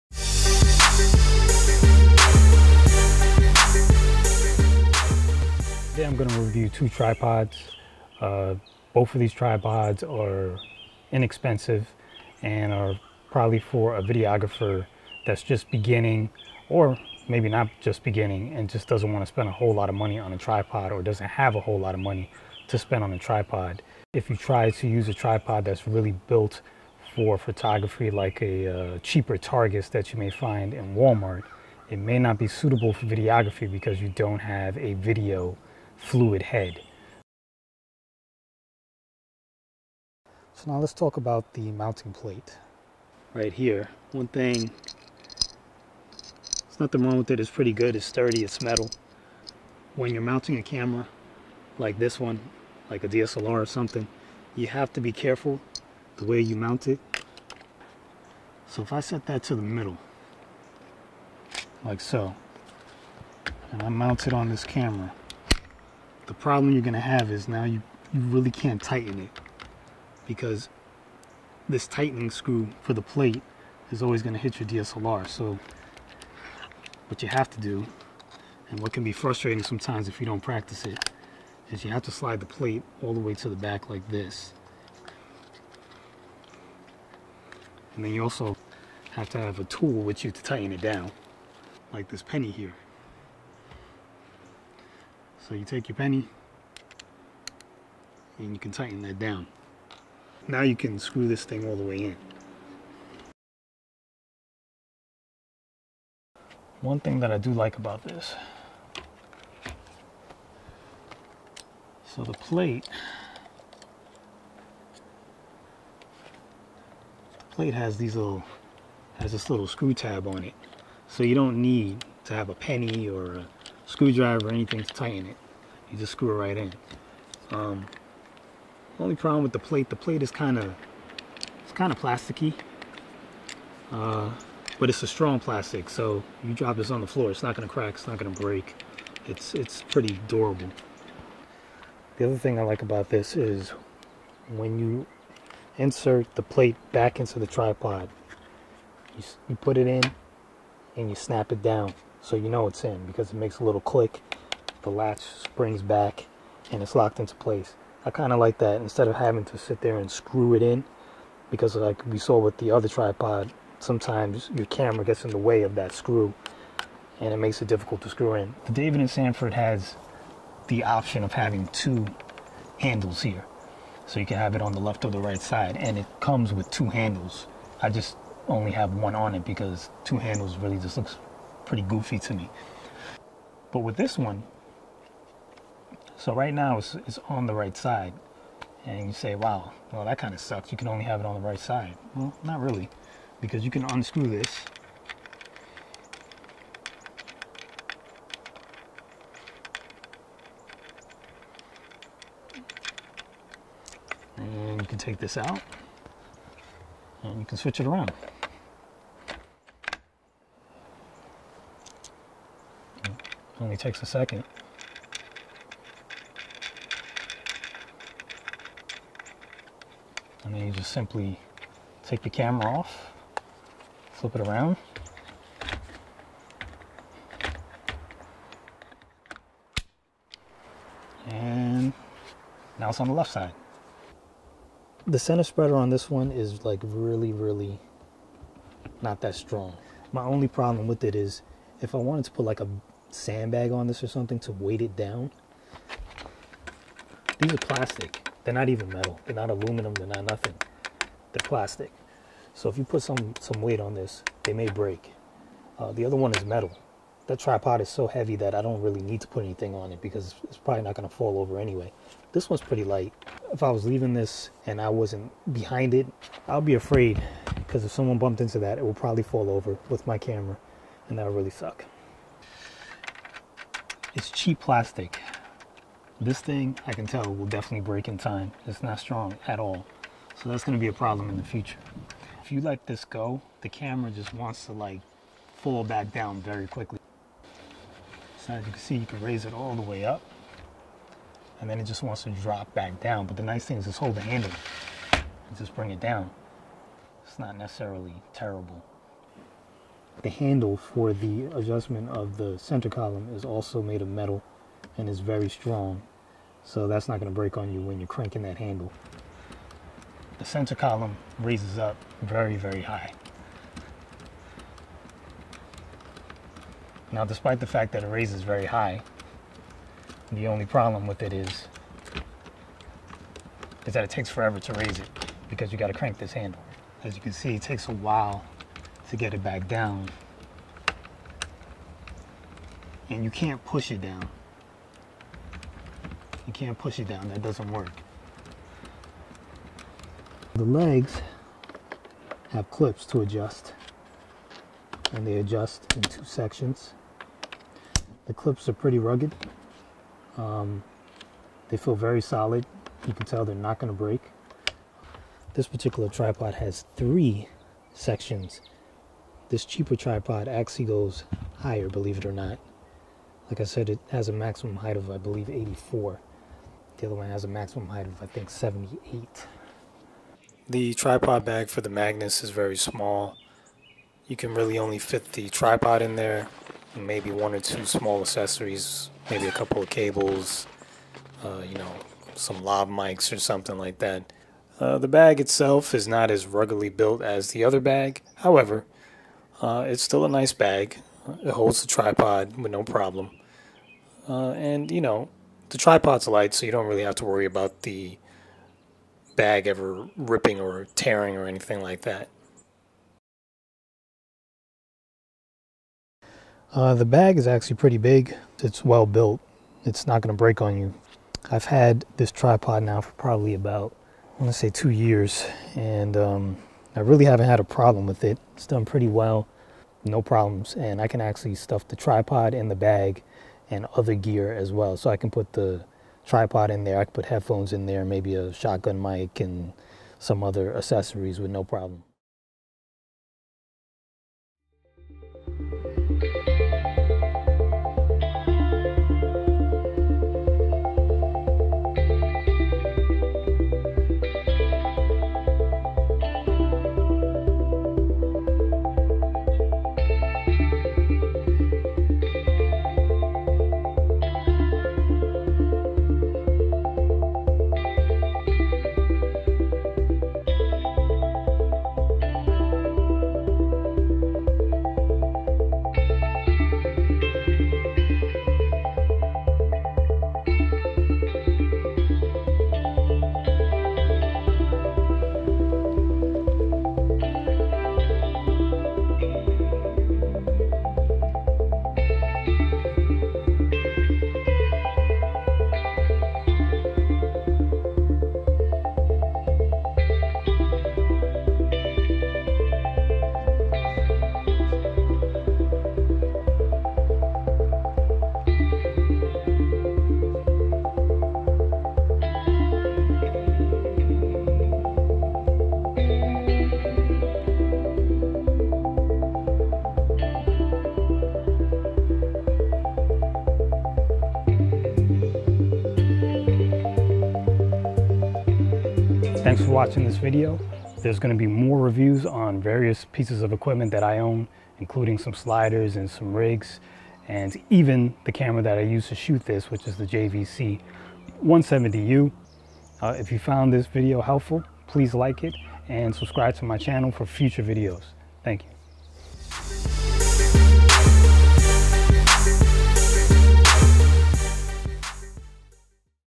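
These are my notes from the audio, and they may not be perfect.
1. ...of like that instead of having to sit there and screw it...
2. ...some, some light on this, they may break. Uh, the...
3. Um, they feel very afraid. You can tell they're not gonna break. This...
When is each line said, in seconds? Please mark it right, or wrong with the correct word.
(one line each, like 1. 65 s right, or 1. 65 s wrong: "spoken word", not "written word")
1. 158 s right
2. 253 s wrong: "weight", not "light"
3. 350 s wrong: "solid", not "afraid".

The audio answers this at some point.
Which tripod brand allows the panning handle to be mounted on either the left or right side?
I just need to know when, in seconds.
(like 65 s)
168 s.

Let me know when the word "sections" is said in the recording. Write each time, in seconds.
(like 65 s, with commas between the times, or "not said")
346 s, 357 s.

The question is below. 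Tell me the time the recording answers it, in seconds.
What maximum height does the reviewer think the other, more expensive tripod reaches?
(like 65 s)
368 s.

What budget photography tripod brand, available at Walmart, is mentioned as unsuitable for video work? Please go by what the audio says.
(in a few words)
Targus.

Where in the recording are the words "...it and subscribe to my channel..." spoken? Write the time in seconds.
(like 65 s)
535 s.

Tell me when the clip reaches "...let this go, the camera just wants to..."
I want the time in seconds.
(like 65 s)
282 s.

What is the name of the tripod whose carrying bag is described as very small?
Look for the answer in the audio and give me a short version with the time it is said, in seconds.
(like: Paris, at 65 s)
Magnus, at 371 s.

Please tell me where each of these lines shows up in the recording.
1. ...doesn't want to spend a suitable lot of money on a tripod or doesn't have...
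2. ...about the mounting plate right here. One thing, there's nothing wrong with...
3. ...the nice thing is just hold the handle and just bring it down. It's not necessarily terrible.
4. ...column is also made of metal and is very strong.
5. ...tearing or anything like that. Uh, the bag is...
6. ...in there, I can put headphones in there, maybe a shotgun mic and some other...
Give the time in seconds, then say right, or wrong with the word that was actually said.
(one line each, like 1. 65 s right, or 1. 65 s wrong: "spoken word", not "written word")
1. 18 s wrong: "whole", not "suitable"
2. 41 s right
3. 293 s right
4. 302 s right
5. 400 s right
6. 426 s right.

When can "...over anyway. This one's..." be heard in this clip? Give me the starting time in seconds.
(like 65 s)
261 s.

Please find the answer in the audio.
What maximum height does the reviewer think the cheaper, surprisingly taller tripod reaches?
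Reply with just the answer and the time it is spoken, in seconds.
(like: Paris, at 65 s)
84, at 365 s.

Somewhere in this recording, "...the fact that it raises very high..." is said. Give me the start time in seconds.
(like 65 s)
317 s.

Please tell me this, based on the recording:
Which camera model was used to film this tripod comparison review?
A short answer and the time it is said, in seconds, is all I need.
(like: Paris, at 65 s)
JVC 170U, at 530 s.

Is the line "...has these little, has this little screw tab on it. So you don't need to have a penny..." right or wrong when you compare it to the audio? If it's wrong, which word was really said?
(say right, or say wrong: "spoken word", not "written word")
right.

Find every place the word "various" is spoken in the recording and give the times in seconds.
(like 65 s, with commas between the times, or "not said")
522 s.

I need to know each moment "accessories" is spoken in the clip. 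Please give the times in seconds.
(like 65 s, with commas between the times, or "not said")
378 s, 430 s.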